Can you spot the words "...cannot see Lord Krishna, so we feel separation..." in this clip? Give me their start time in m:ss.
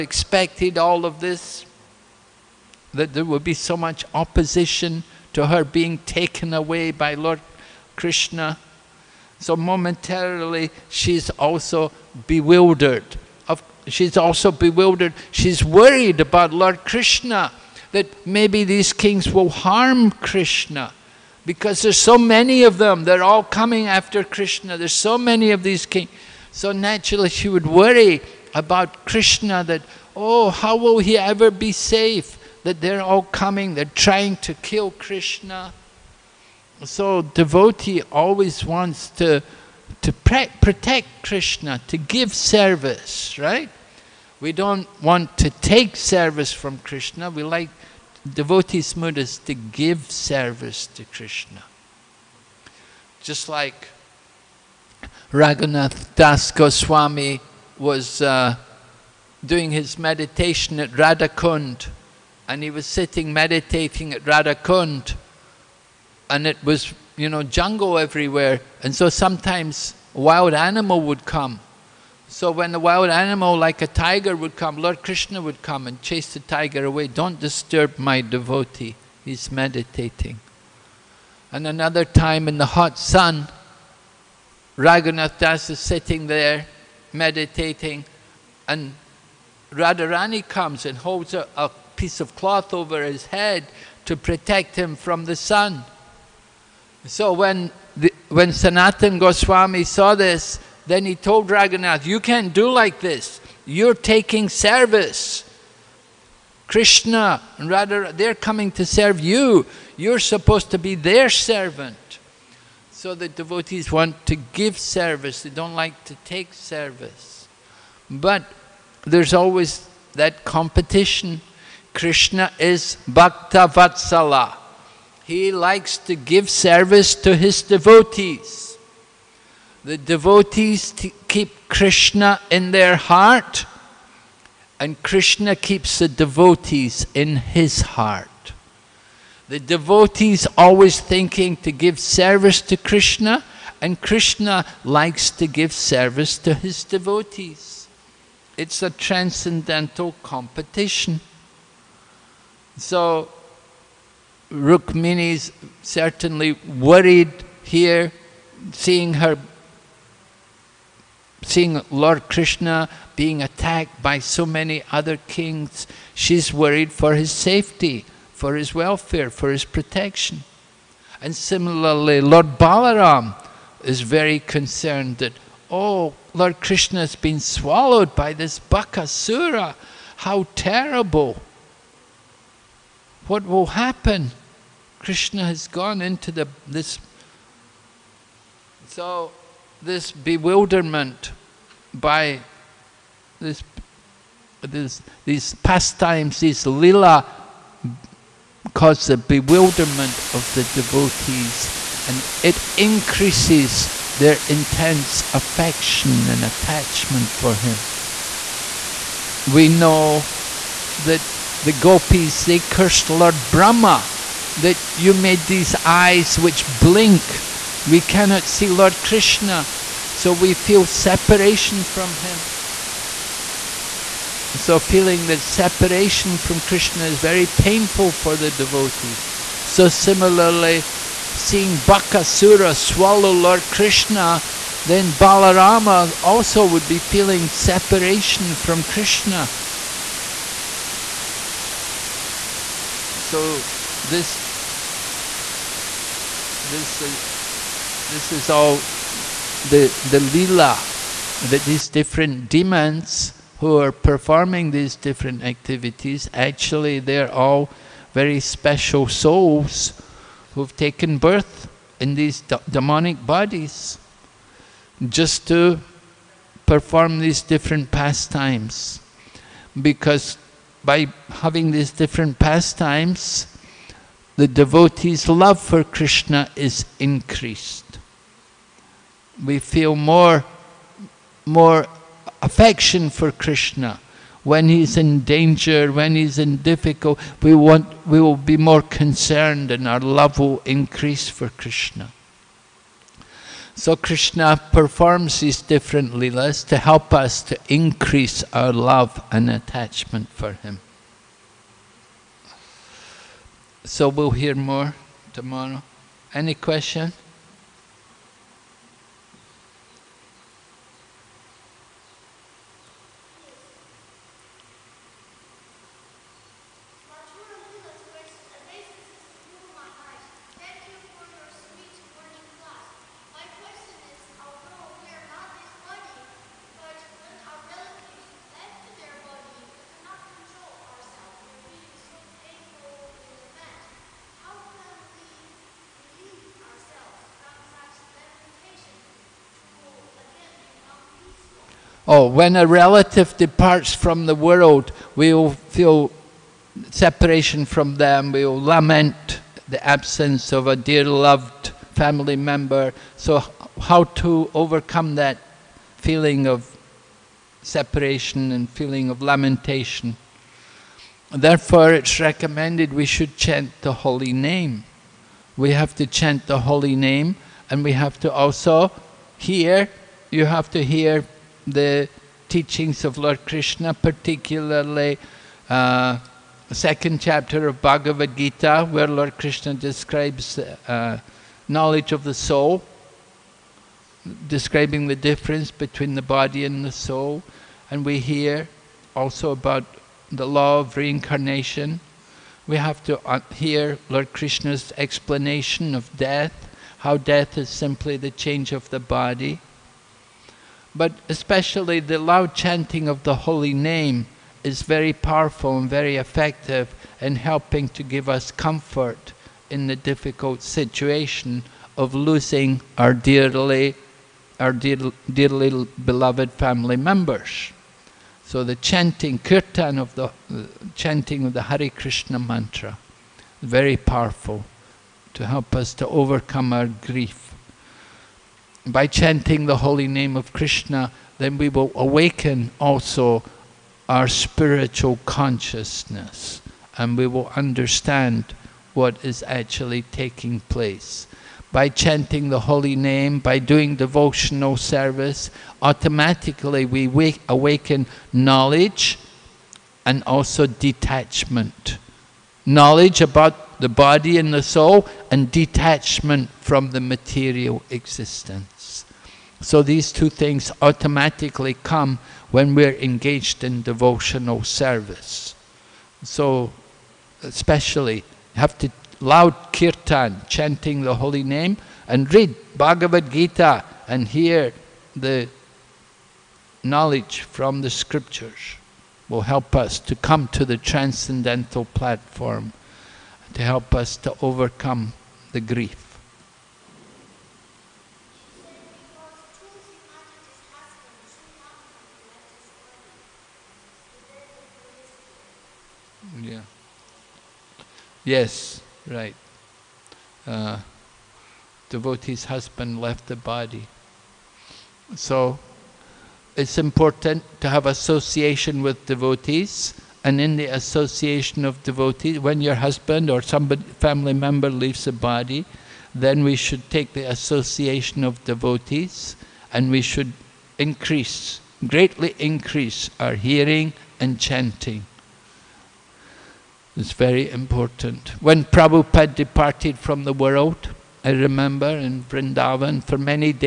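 3:38.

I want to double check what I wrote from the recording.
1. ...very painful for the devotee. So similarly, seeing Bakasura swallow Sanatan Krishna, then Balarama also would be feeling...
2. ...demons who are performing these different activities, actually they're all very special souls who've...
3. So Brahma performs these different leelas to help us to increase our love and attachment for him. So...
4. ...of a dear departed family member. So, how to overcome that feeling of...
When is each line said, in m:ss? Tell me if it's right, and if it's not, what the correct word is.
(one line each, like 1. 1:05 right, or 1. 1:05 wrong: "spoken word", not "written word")
1. 3:47 wrong: "Lord", not "Sanatan"
2. 4:12 right
3. 4:53 wrong: "Krishna", not "Brahma"
4. 5:50 wrong: "loved", not "departed".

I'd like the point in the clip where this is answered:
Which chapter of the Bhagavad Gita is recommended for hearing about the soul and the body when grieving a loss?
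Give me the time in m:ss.
6:16.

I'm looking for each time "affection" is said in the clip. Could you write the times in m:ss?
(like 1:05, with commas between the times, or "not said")
3:25, 4:42.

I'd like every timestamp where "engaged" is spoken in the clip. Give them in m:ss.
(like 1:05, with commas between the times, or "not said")
7:42.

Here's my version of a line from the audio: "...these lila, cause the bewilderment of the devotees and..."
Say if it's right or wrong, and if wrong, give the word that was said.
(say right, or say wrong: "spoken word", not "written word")
right.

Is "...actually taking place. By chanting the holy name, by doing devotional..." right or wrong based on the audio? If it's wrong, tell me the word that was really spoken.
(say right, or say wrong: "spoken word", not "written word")
right.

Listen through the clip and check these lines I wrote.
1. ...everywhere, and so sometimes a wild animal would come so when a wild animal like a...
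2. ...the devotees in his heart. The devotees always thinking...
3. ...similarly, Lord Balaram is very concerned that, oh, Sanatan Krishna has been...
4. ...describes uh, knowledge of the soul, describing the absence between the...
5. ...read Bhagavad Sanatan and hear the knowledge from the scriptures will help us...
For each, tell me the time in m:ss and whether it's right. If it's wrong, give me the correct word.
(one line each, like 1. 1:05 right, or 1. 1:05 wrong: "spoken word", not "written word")
1. 1:07 right
2. 2:15 right
3. 2:51 wrong: "Lord", not "Sanatan"
4. 6:19 wrong: "difference", not "absence"
5. 7:52 wrong: "Gita", not "Sanatan".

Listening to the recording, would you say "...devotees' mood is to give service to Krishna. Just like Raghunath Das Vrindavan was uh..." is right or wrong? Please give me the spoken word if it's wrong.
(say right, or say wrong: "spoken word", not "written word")
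wrong: "Goswami", not "Vrindavan".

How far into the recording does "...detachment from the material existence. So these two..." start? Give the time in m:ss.
7:35.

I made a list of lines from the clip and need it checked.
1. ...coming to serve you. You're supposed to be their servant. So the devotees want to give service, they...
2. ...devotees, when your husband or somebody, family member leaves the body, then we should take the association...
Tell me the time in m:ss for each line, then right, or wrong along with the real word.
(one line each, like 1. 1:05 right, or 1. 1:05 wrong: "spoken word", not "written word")
1. 1:48 right
2. 8:31 right.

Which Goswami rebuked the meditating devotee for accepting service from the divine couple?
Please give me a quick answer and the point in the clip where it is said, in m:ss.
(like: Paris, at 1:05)
Sanatan Goswami, at 1:38.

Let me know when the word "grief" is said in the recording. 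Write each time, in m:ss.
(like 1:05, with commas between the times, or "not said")
7:06, 8:05.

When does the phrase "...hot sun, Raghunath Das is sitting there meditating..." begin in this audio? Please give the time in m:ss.
1:22.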